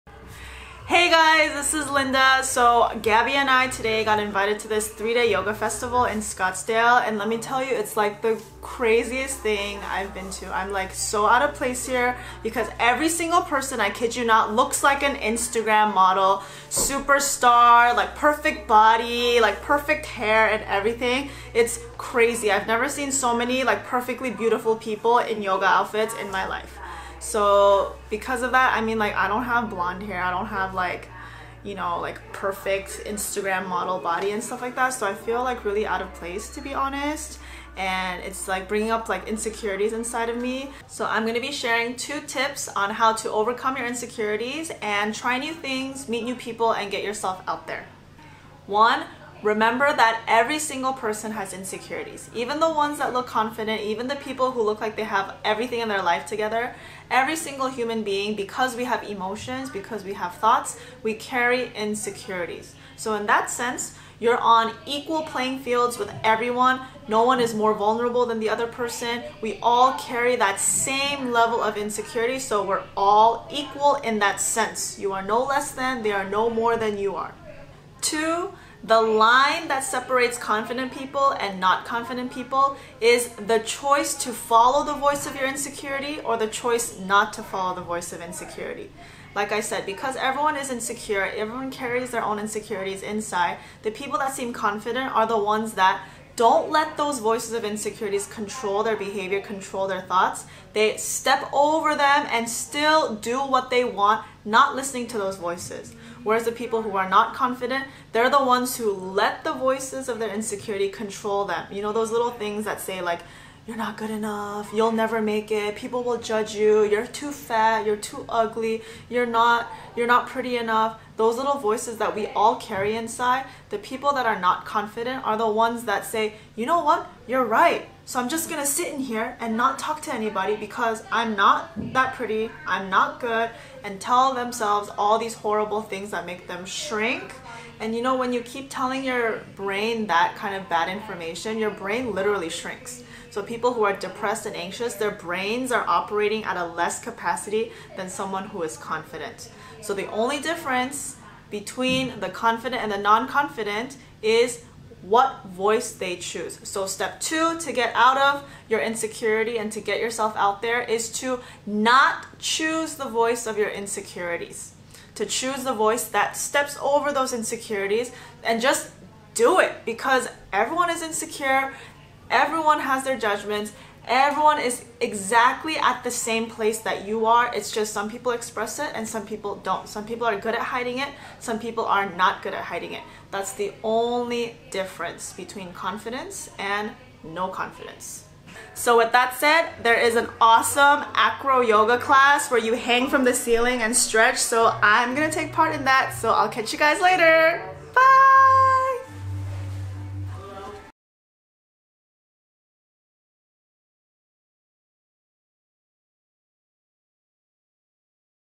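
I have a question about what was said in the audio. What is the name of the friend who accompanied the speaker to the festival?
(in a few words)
Gabby.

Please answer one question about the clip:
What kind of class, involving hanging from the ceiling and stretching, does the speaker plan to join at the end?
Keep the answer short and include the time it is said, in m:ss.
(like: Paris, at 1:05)
Acro yoga, at 3:11.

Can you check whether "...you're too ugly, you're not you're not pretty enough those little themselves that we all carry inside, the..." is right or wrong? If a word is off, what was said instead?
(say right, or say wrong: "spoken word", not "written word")
wrong: "voices", not "themselves".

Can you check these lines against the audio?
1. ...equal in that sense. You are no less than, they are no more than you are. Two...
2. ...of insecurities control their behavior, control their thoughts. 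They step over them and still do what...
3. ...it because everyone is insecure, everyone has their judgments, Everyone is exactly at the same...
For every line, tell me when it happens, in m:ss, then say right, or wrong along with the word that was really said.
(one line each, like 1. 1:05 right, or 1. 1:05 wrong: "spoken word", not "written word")
1. 1:13 right
2. 1:37 right
3. 2:49 right.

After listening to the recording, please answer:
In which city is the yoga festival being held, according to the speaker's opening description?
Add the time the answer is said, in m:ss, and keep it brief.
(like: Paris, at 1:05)
Scottsdale, at 0:06.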